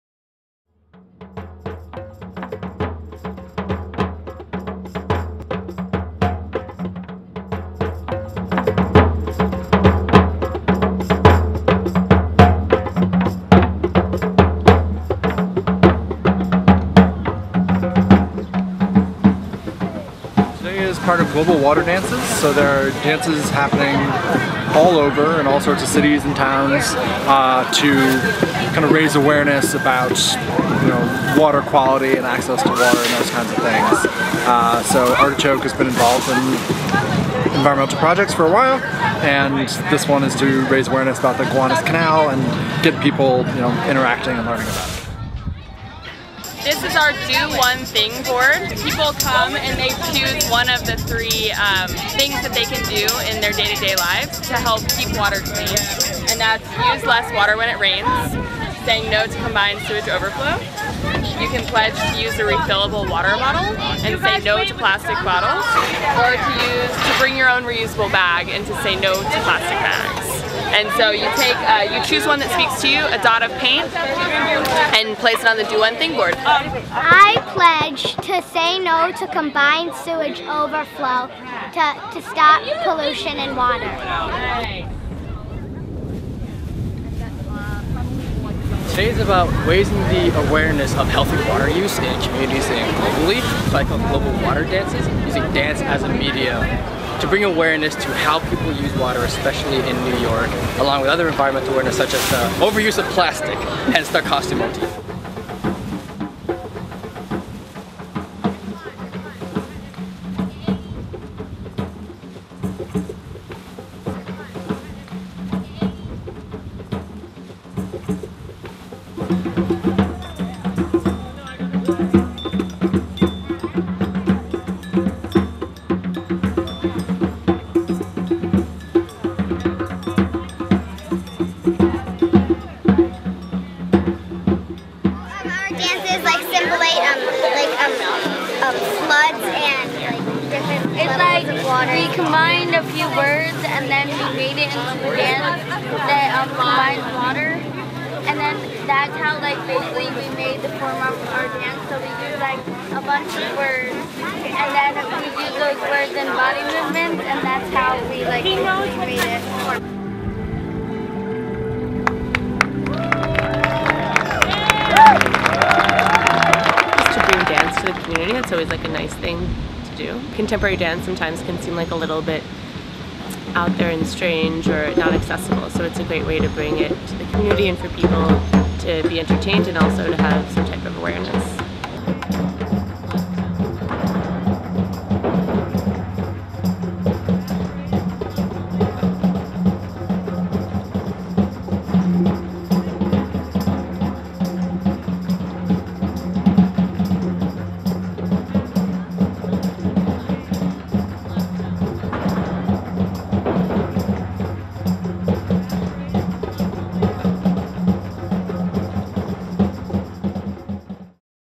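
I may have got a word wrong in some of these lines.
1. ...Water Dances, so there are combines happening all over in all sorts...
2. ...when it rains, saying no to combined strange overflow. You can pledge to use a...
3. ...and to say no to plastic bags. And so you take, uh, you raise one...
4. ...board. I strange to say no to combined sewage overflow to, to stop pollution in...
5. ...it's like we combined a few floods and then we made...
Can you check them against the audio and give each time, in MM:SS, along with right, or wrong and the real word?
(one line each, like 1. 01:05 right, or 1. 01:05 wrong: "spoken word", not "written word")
1. 00:21 wrong: "dances", not "combines"
2. 00:57 wrong: "sewage", not "strange"
3. 01:08 wrong: "choose", not "raise"
4. 01:16 wrong: "pledge", not "strange"
5. 02:20 wrong: "words", not "floods".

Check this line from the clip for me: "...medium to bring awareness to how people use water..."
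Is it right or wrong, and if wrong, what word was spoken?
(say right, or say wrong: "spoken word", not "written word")
right.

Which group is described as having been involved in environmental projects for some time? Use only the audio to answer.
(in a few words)
Artichoke.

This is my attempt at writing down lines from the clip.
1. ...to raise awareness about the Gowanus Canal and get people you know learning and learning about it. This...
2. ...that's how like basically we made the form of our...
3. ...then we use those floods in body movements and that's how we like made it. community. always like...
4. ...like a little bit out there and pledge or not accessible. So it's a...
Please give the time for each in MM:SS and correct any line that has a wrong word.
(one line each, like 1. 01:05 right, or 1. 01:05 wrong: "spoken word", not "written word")
1. 00:40 wrong: "interacting", not "learning"
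2. 02:28 right
3. 02:34 wrong: "words", not "floods"
4. 02:51 wrong: "strange", not "pledge".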